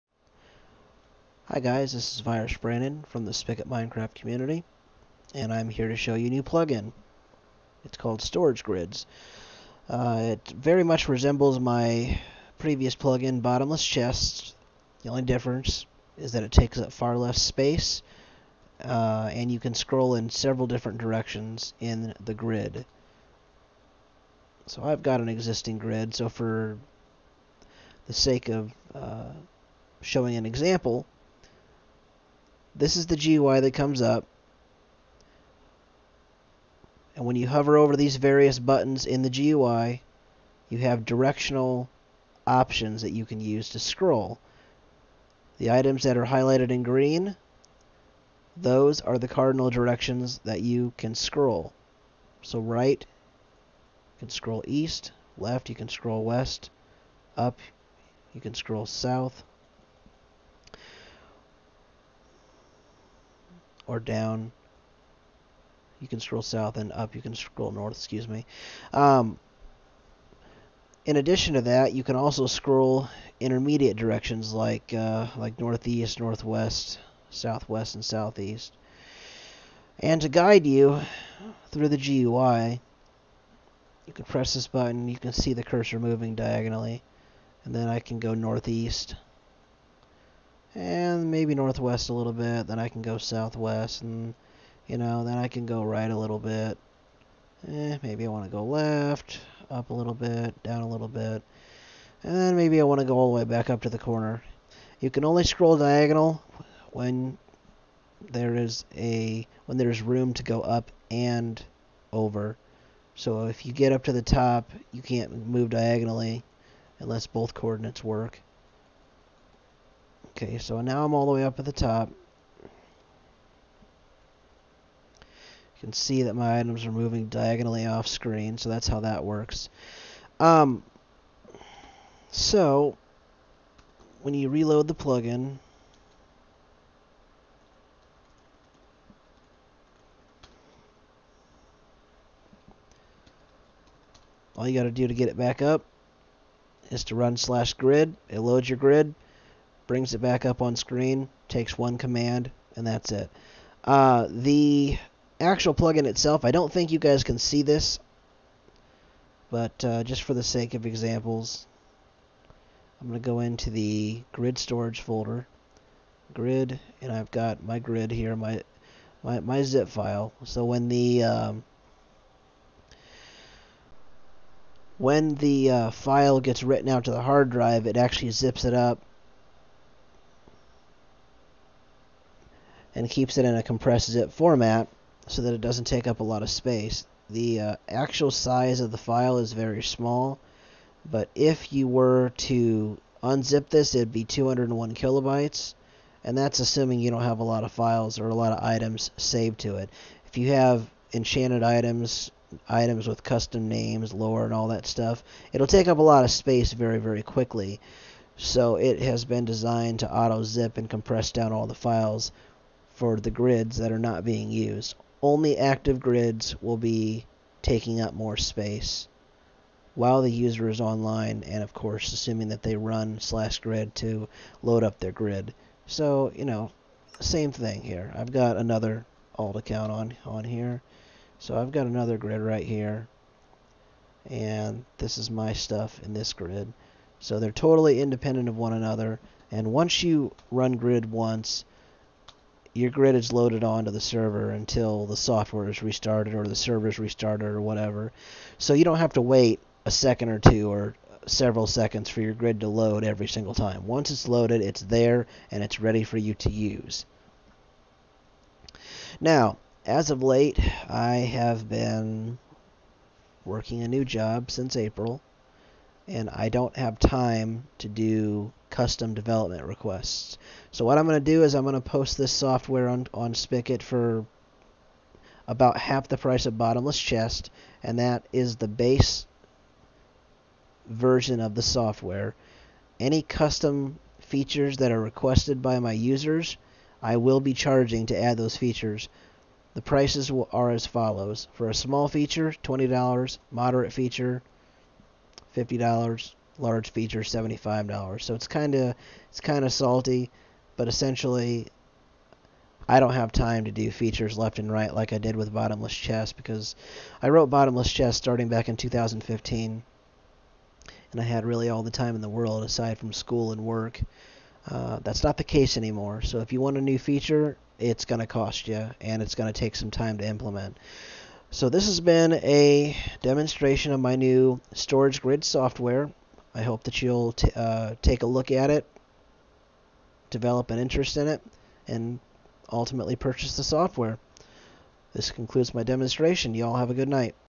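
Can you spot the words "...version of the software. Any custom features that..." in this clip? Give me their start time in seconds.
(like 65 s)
280 s.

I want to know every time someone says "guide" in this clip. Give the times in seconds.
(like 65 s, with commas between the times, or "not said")
80 s.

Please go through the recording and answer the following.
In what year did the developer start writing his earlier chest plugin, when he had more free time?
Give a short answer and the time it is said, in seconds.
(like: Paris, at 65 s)
2015, at 308 s.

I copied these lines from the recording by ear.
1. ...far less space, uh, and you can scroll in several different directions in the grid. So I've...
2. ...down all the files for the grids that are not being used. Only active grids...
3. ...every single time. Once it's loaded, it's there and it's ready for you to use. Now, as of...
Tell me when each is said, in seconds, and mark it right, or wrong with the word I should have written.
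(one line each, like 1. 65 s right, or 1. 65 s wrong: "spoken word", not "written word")
1. 16 s right
2. 211 s right
3. 253 s right.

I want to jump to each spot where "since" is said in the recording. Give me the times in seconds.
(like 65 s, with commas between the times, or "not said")
264 s.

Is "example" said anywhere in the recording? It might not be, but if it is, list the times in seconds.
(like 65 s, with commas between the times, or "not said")
30 s, 160 s.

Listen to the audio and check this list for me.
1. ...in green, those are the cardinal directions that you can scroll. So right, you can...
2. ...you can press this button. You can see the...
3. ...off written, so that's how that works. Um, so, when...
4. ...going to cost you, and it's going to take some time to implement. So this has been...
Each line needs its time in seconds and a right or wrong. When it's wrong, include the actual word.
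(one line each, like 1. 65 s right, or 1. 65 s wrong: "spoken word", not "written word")
1. 46 s right
2. 84 s right
3. 127 s wrong: "screen", not "written"
4. 318 s right.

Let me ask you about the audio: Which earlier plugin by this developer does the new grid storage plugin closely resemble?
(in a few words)
Bottomless Chests.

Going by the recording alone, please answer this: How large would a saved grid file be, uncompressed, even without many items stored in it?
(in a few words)
201 kilobytes.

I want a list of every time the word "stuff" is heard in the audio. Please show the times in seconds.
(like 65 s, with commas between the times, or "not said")
204 s, 235 s.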